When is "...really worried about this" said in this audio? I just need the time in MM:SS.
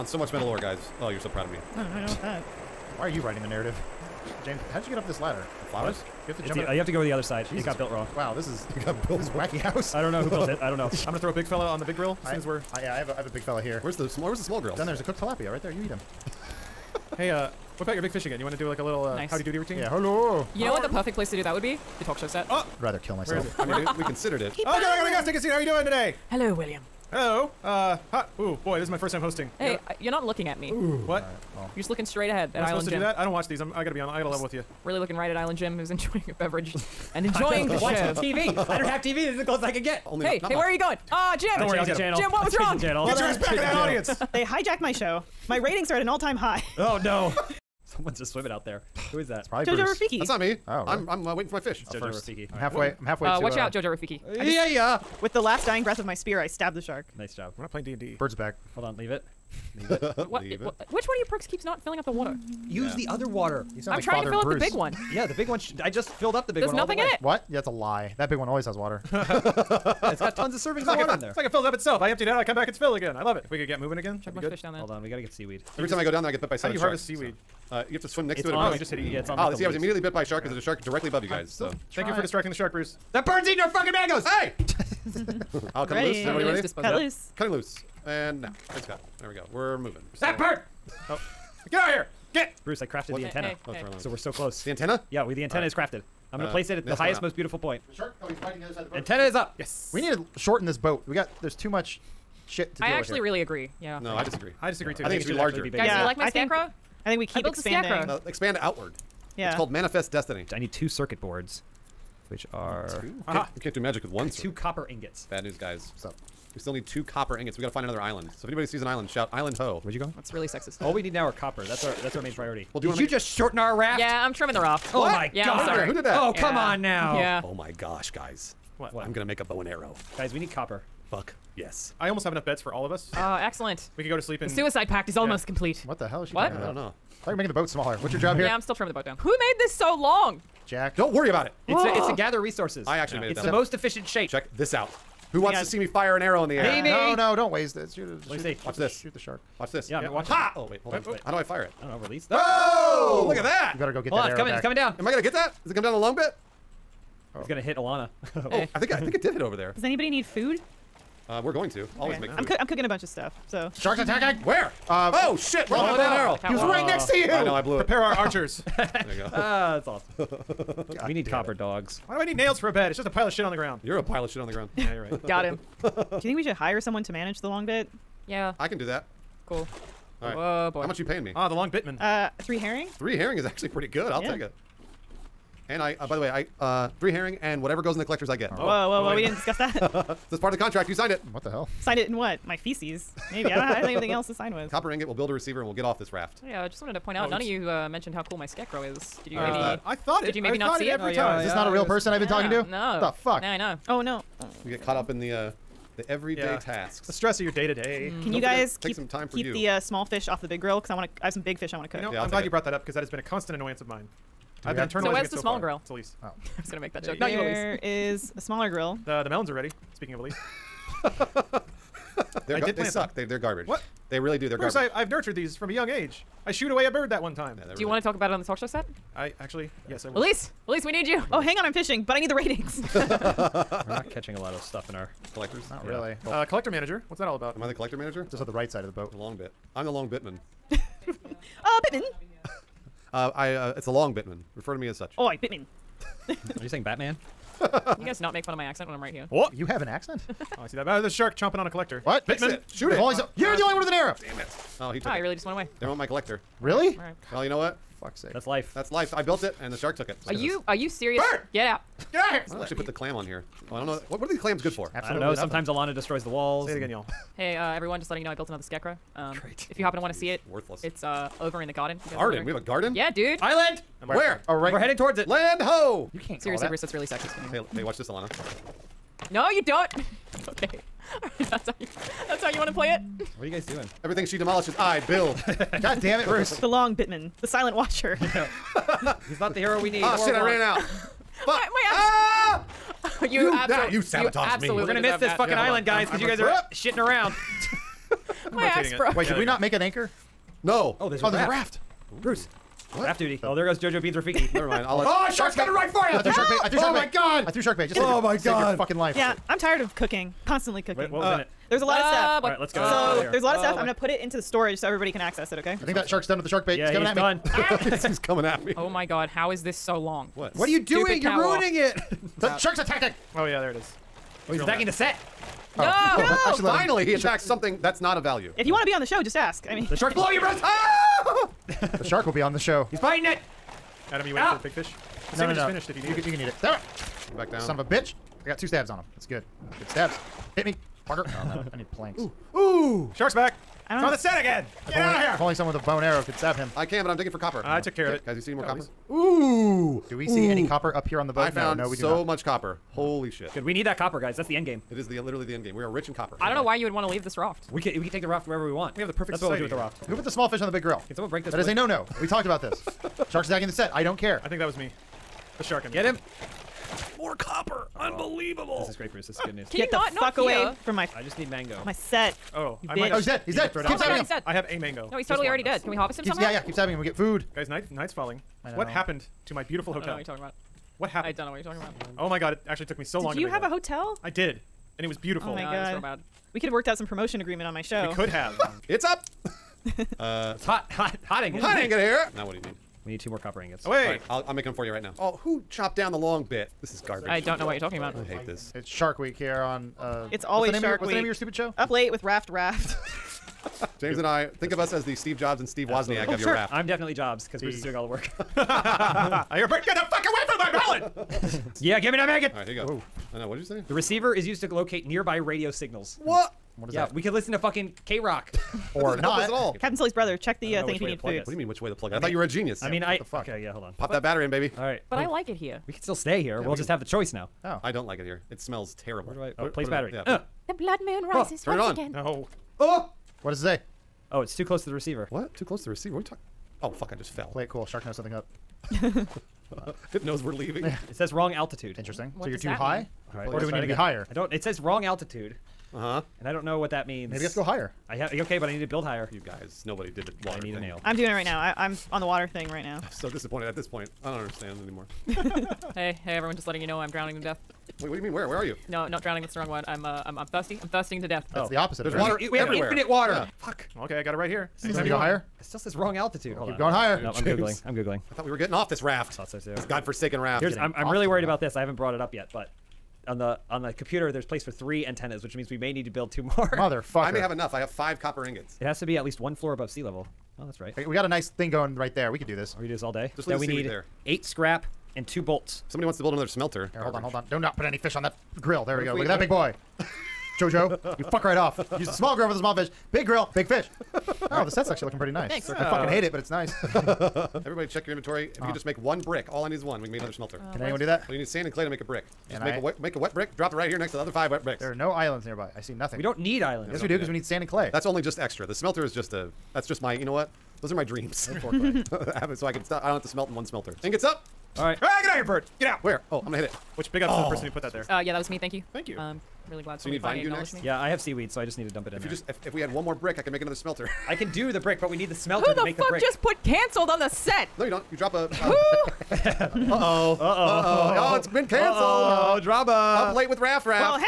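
07:51.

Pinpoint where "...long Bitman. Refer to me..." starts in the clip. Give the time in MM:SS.
04:03.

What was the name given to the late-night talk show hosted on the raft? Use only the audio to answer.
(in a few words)
Up late with Raft Raft.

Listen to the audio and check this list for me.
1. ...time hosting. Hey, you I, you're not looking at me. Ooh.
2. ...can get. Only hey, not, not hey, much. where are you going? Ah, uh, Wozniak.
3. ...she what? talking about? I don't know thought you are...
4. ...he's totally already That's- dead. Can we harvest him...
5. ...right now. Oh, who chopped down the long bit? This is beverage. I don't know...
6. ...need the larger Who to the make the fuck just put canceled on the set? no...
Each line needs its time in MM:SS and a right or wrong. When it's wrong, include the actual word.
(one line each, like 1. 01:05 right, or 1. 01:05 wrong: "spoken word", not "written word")
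1. 00:29 right
2. 00:39 wrong: "Jim", not "Wozniak"
3. 02:16 right
4. 06:15 right
5. 06:34 wrong: "garbage", not "beverage"
6. 08:45 wrong: "smelter", not "larger".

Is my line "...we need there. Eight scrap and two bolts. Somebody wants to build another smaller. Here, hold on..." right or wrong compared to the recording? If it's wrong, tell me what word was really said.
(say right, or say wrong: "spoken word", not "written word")
wrong: "smelter", not "smaller".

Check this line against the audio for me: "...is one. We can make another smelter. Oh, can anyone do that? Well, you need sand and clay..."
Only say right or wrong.
right.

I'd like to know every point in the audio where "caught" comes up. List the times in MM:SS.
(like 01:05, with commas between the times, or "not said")
03:24.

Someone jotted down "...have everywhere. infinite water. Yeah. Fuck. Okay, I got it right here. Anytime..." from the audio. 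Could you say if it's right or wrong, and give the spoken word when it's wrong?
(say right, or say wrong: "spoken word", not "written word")
right.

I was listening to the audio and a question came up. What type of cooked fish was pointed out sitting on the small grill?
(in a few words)
tilapia.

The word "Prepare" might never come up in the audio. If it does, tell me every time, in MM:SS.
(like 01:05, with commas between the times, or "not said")
02:47.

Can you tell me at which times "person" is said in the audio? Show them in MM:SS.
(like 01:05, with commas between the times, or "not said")
03:21, 08:37.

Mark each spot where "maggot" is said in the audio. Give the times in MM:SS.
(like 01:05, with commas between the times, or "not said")
06:52.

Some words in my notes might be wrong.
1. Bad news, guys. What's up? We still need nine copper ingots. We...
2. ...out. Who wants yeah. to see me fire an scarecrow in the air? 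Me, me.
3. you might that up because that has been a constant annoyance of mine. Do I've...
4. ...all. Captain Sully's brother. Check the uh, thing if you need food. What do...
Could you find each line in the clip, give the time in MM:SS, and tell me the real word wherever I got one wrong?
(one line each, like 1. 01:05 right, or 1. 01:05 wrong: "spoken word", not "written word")
1. 01:55 wrong: "two", not "nine"
2. 02:24 wrong: "arrow", not "scarecrow"
3. 03:32 wrong: "brought", not "might"
4. 06:59 right.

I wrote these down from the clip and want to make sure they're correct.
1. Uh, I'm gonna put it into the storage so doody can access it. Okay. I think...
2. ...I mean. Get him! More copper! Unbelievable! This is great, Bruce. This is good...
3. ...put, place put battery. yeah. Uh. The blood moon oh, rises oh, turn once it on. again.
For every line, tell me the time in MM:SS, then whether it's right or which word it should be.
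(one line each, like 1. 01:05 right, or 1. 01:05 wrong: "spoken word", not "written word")
1. 05:13 wrong: "everybody", not "doody"
2. 06:05 right
3. 07:09 right.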